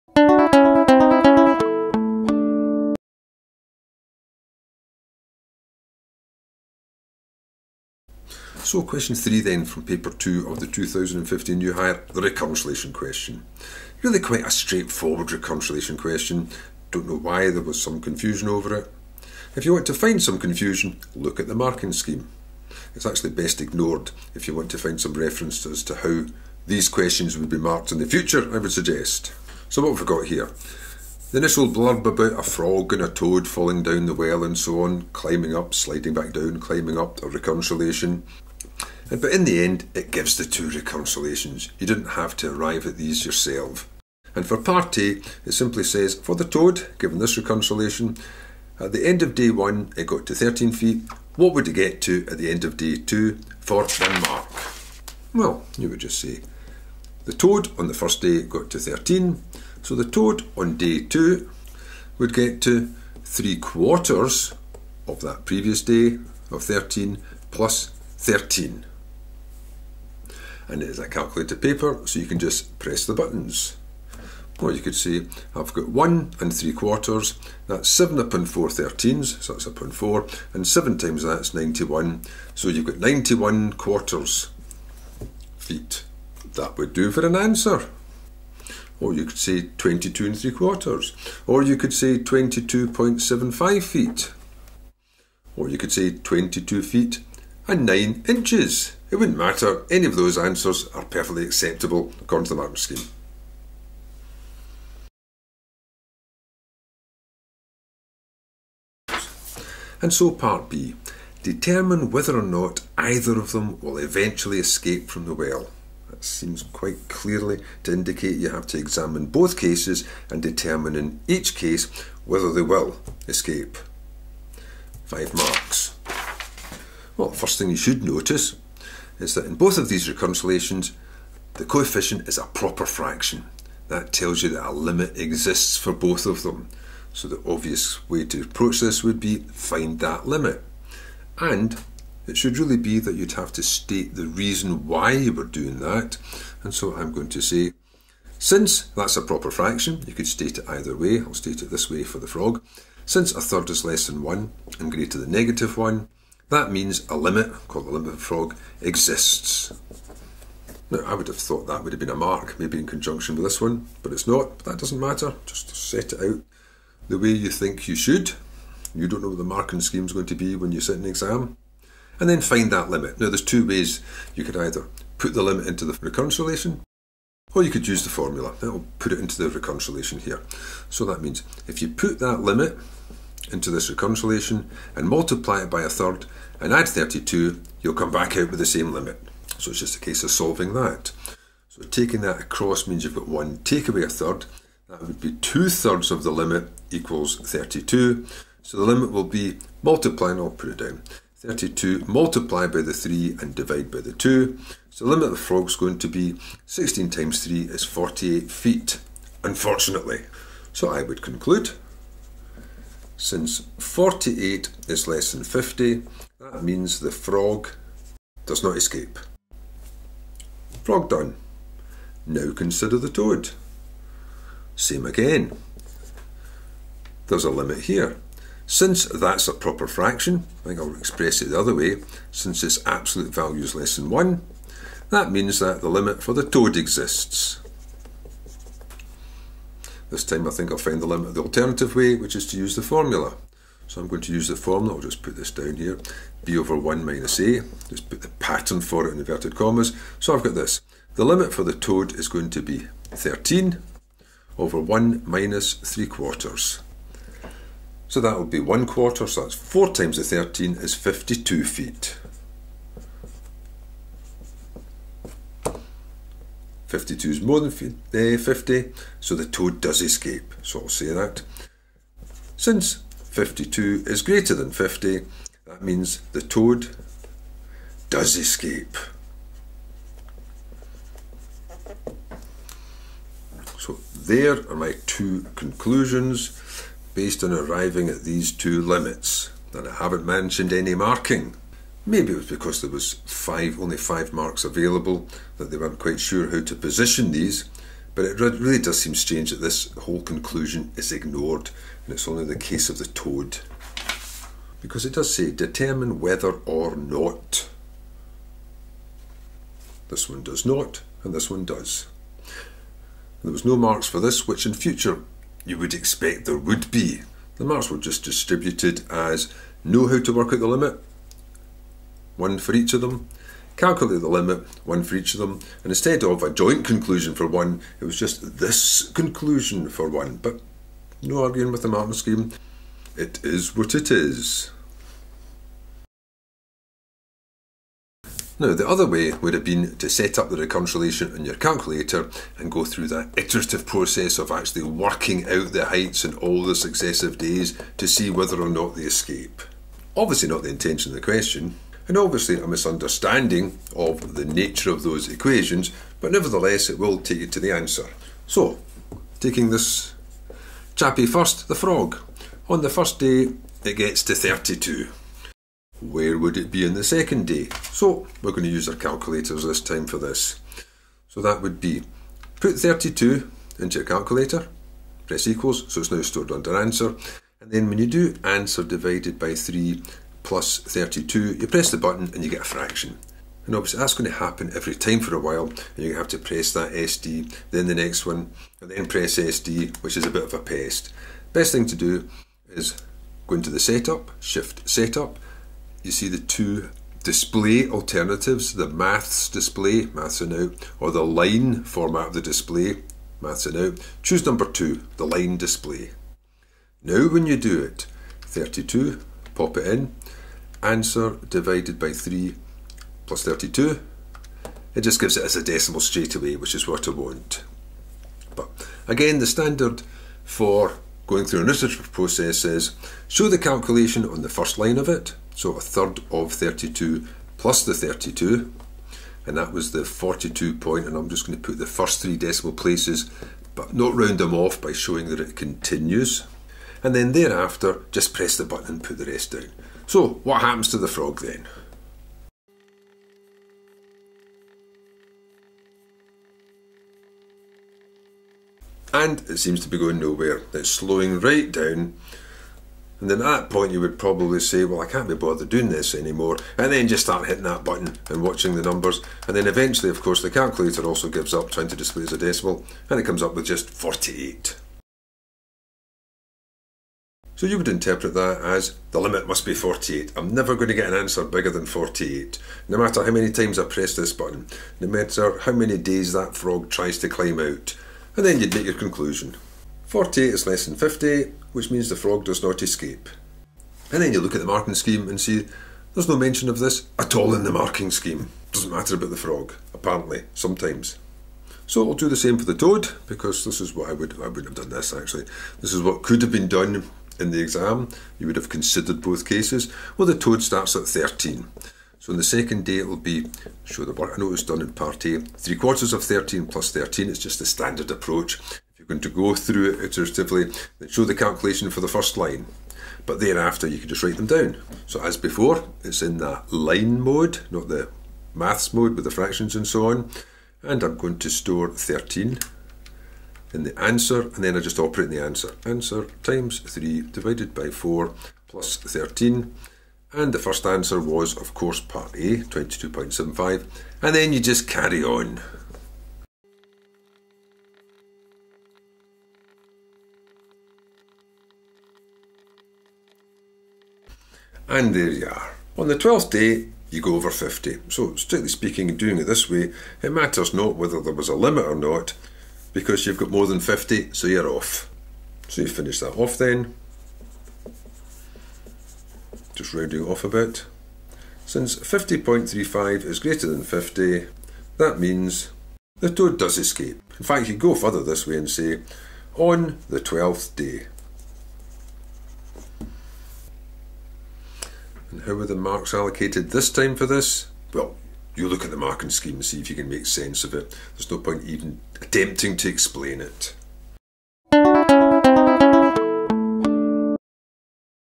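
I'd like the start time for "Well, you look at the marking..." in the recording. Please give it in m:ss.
9:37.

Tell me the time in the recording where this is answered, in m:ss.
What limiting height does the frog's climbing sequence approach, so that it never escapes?
3:27.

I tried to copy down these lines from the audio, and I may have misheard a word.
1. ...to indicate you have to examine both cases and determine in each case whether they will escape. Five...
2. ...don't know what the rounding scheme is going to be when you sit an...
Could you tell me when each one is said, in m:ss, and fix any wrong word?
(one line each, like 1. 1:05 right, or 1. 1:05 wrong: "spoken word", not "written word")
1. 1:57 right
2. 2:49 wrong: "marking", not "rounding".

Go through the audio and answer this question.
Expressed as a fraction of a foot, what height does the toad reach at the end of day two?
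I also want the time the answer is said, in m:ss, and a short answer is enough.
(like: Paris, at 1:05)
91 quarters, at 1:22.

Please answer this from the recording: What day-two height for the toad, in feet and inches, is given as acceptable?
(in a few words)
22 feet 9 inches.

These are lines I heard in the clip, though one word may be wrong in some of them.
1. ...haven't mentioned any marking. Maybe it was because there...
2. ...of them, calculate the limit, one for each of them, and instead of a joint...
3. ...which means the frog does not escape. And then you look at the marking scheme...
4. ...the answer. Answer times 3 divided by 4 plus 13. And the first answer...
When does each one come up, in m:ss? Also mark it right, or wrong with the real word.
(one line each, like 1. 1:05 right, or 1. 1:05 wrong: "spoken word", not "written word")
1. 4:49 right
2. 5:22 right
3. 8:01 right
4. 8:45 right.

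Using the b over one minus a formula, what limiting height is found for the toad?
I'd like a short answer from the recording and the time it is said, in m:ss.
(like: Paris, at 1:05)
52 feet, at 4:20.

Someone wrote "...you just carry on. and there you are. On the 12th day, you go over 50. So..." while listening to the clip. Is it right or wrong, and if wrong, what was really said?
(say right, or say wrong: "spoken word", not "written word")
right.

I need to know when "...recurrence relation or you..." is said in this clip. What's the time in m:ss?
2:56.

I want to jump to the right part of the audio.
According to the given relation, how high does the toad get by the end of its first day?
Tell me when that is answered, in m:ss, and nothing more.
0:50.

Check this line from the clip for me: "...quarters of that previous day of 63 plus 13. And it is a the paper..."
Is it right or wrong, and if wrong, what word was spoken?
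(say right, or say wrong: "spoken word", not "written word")
wrong: "13", not "63".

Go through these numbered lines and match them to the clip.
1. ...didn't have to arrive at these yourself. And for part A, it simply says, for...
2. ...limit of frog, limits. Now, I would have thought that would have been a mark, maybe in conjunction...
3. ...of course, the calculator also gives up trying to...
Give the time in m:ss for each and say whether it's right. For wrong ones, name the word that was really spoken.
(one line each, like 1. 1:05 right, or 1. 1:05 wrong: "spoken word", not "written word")
1. 0:41 right
2. 2:37 wrong: "exists", not "limits"
3. 7:40 right.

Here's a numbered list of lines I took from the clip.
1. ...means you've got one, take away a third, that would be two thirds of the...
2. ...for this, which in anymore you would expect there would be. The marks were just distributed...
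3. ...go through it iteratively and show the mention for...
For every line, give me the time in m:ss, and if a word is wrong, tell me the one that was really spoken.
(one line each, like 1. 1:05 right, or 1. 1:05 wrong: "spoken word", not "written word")
1. 3:12 right
2. 5:14 wrong: "future", not "anymore"
3. 8:29 wrong: "calculation", not "mention".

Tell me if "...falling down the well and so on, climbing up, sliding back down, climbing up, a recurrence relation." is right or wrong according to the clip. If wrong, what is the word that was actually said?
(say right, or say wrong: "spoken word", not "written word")
right.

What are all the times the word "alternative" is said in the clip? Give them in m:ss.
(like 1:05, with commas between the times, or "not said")
4:01, 6:37.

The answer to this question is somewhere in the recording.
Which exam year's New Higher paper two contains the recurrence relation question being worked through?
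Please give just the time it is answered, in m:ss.
0:10.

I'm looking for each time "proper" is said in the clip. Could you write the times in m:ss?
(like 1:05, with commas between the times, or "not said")
2:12, 2:29, 3:49.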